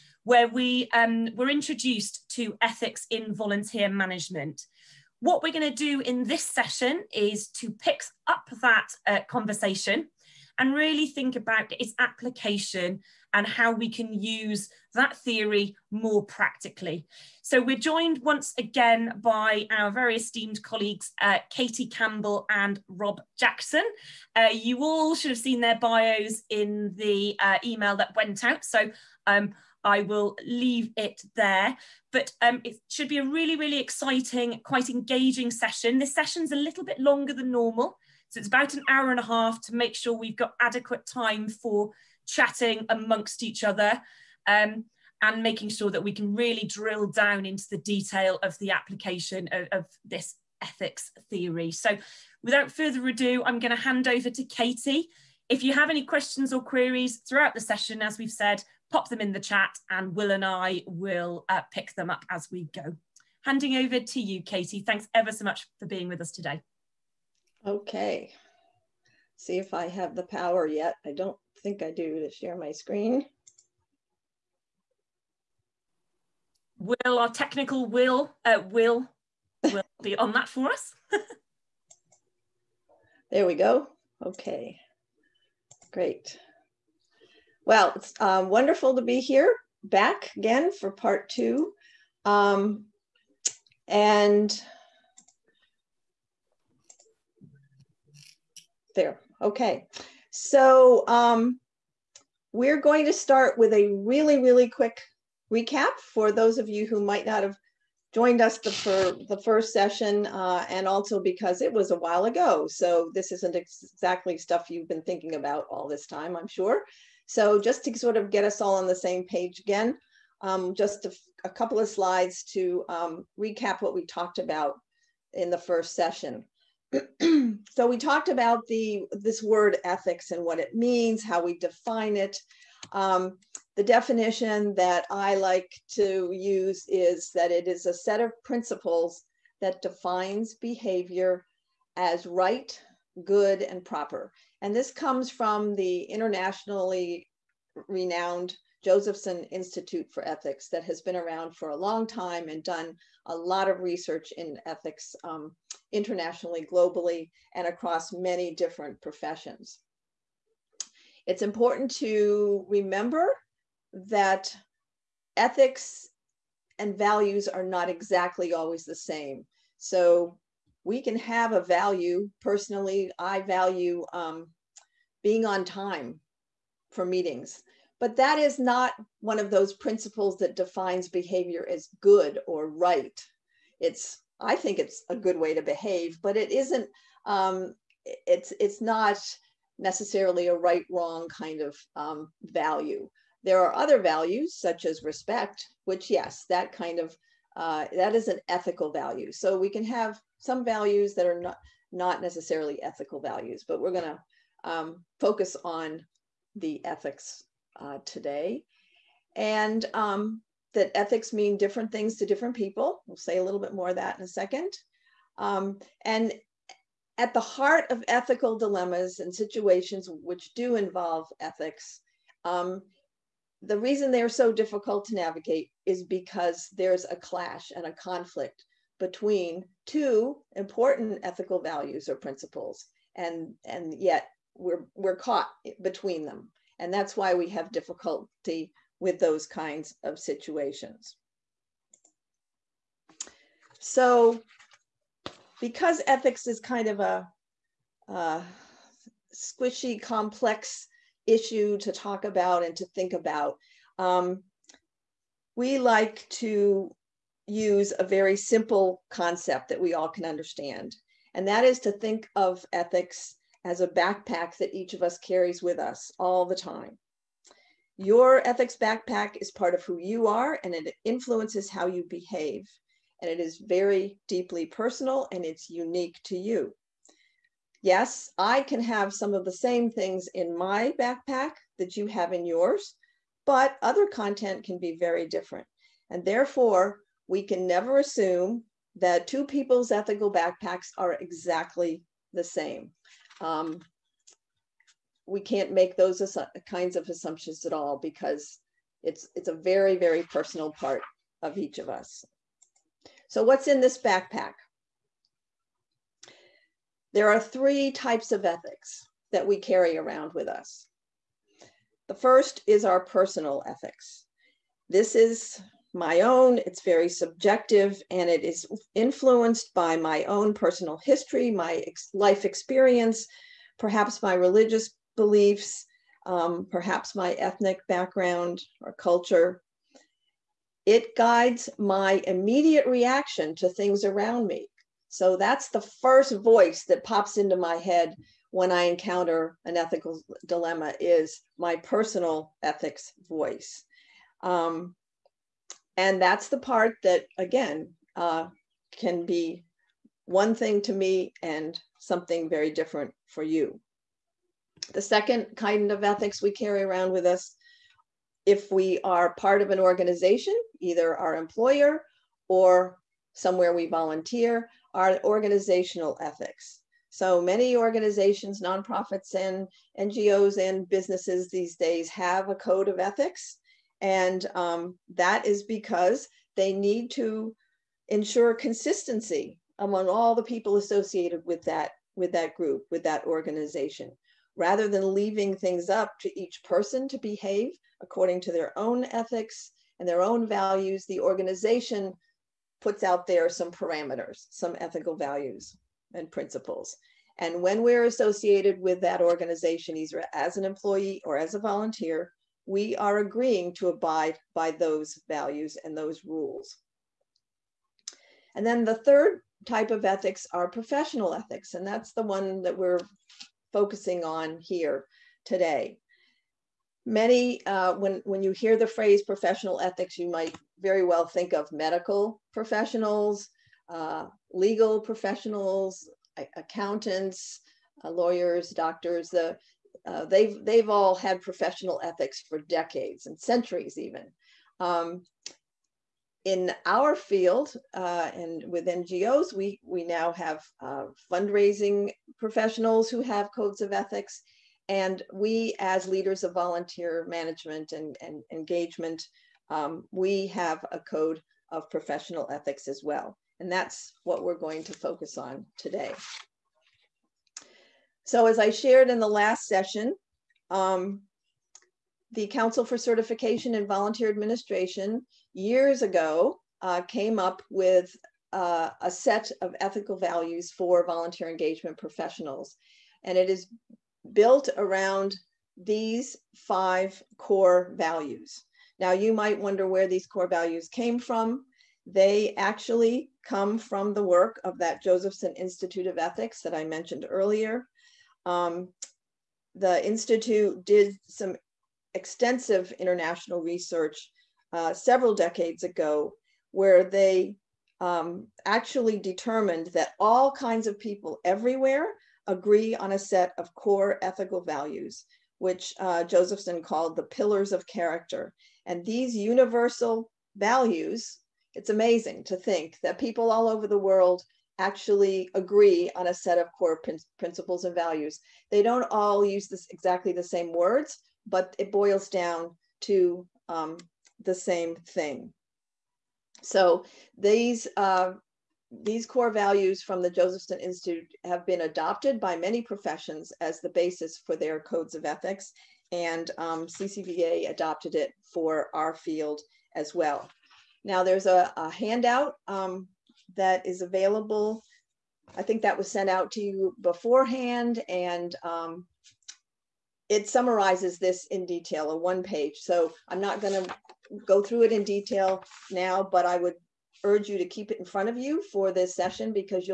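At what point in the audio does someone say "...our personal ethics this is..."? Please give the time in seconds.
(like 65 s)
312 s.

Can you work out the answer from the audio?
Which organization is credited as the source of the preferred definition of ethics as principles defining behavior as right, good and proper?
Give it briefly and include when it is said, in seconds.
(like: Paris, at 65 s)
Josephson Institute for Ethics, at 148 s.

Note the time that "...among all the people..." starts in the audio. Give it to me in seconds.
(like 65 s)
379 s.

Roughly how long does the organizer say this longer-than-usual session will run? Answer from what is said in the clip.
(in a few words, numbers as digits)
an hour and a half.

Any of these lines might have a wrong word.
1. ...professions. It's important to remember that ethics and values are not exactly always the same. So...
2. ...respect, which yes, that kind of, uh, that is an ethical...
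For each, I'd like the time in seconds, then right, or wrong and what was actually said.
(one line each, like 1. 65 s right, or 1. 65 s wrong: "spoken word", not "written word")
1. 159 s right
2. 195 s right.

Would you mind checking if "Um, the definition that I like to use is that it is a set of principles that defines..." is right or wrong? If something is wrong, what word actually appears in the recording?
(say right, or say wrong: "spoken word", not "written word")
right.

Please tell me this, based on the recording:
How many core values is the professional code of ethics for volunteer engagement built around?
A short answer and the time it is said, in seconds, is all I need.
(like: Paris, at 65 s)
5, at 476 s.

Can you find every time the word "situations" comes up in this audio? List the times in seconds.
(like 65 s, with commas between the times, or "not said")
219 s, 240 s.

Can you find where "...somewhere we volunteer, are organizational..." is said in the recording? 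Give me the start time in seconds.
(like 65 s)
363 s.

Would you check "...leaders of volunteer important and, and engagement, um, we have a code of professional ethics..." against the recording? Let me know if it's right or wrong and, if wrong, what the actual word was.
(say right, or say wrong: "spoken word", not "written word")
wrong: "management", not "important".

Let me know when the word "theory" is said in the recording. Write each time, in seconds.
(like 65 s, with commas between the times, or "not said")
15 s, 51 s.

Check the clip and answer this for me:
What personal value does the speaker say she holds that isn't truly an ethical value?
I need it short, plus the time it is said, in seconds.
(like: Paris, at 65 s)
being on time for meetings, at 175 s.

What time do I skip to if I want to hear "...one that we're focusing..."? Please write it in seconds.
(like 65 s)
412 s.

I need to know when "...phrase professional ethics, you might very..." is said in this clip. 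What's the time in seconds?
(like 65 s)
418 s.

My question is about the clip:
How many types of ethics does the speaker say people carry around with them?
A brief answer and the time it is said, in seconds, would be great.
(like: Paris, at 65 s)
3, at 307 s.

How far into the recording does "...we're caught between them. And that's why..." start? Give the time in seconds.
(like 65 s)
234 s.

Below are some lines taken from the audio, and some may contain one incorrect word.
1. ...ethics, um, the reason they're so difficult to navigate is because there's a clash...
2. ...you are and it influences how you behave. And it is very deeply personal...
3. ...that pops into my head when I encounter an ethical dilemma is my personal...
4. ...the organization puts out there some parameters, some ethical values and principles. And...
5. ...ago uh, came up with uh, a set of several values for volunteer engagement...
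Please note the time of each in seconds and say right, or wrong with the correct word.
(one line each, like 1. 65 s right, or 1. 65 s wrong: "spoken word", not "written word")
1. 221 s right
2. 269 s right
3. 336 s right
4. 391 s right
5. 466 s wrong: "ethical", not "several".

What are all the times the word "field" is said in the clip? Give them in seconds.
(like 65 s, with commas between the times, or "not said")
437 s, 539 s.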